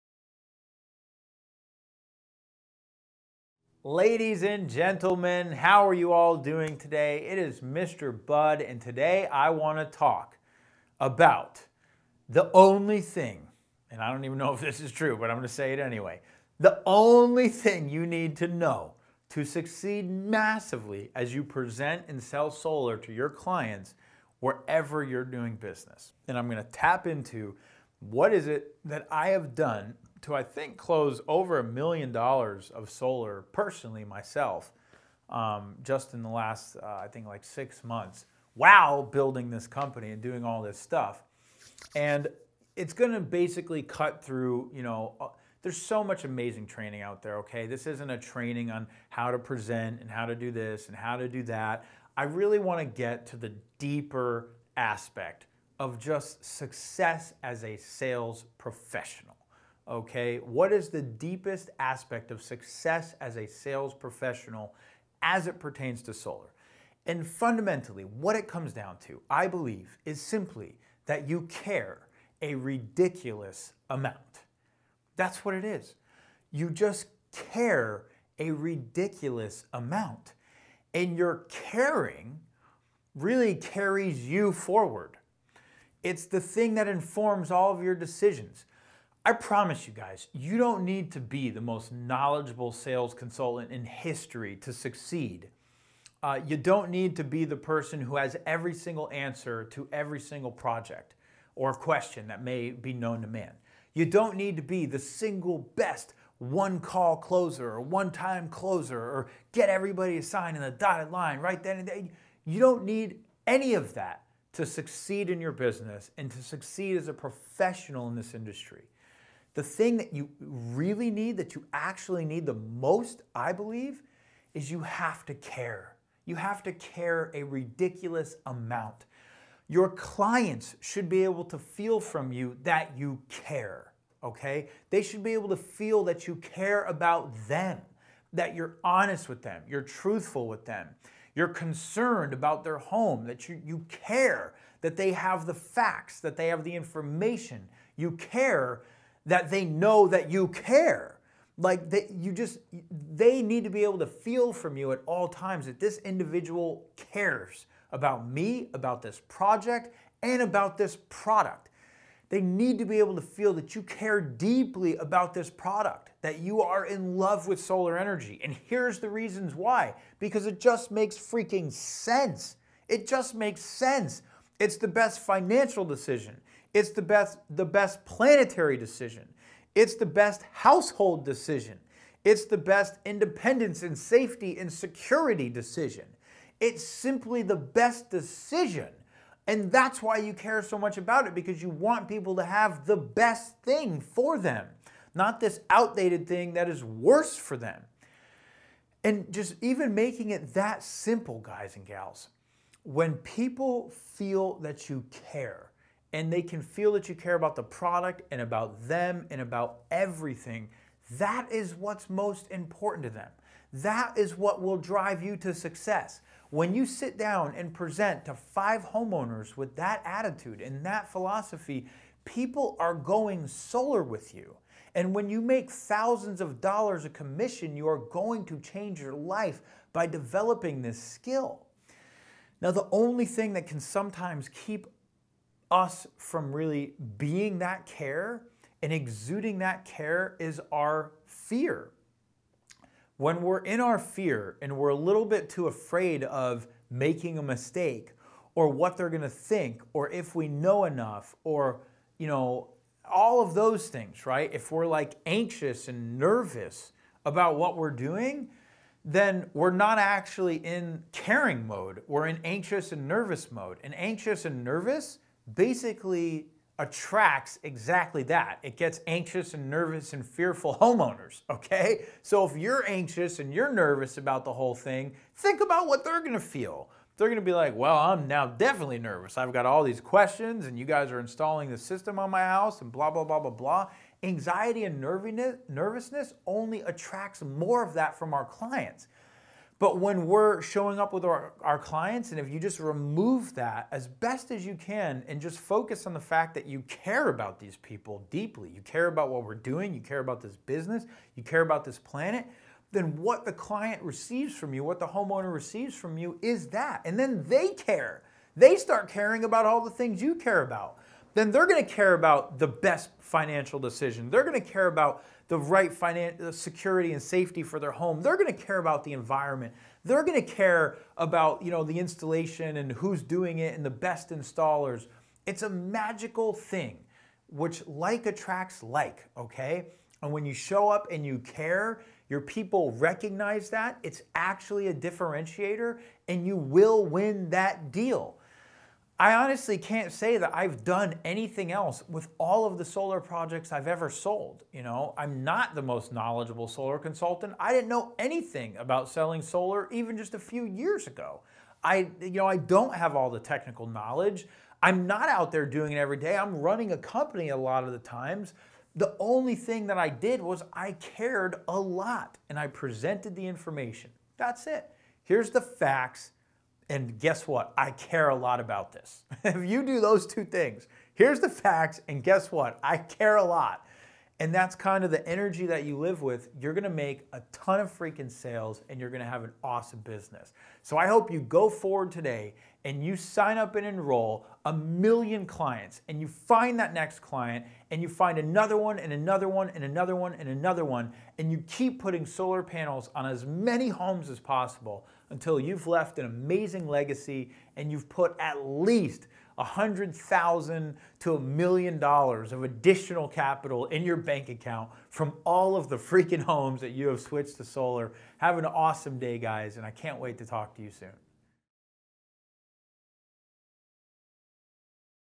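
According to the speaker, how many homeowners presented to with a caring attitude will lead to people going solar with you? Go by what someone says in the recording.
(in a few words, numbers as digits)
5.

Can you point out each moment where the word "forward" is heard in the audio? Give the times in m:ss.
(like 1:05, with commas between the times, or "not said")
1:24, 6:21.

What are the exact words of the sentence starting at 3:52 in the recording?
Now, the only thing that can sometimes keep us from really being that care and exuding that care is our fear.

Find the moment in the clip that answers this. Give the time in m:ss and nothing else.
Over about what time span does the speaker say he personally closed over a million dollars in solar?
0:37.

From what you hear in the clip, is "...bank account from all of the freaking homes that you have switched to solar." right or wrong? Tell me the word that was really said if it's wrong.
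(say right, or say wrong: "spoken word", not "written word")
right.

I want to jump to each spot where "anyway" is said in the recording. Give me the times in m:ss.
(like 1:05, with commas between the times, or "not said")
0:15.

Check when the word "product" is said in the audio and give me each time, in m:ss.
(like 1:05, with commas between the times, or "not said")
2:41, 2:45, 3:27.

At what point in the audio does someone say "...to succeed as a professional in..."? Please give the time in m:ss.
1:56.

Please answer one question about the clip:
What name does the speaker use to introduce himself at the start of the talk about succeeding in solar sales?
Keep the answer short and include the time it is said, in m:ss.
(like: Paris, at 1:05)
Mr. Budd, at 0:07.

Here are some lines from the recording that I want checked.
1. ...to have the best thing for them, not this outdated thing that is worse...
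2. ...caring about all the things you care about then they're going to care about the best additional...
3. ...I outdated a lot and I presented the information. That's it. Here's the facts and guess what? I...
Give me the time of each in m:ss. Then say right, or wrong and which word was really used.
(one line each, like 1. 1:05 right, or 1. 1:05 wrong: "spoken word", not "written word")
1. 3:12 right
2. 5:09 wrong: "financial", not "additional"
3. 6:00 wrong: "cared", not "outdated".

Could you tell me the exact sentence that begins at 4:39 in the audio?
I've got all these questions and you guys are installing the system on my house and blah, blah, blah, blah, blah.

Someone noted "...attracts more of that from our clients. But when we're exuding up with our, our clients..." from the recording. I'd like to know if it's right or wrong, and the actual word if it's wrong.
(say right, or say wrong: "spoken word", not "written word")
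wrong: "showing", not "exuding".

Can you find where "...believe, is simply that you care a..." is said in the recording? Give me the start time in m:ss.
1:09.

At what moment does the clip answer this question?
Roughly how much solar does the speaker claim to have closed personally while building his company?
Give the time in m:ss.
0:31.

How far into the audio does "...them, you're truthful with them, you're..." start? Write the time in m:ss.
2:19.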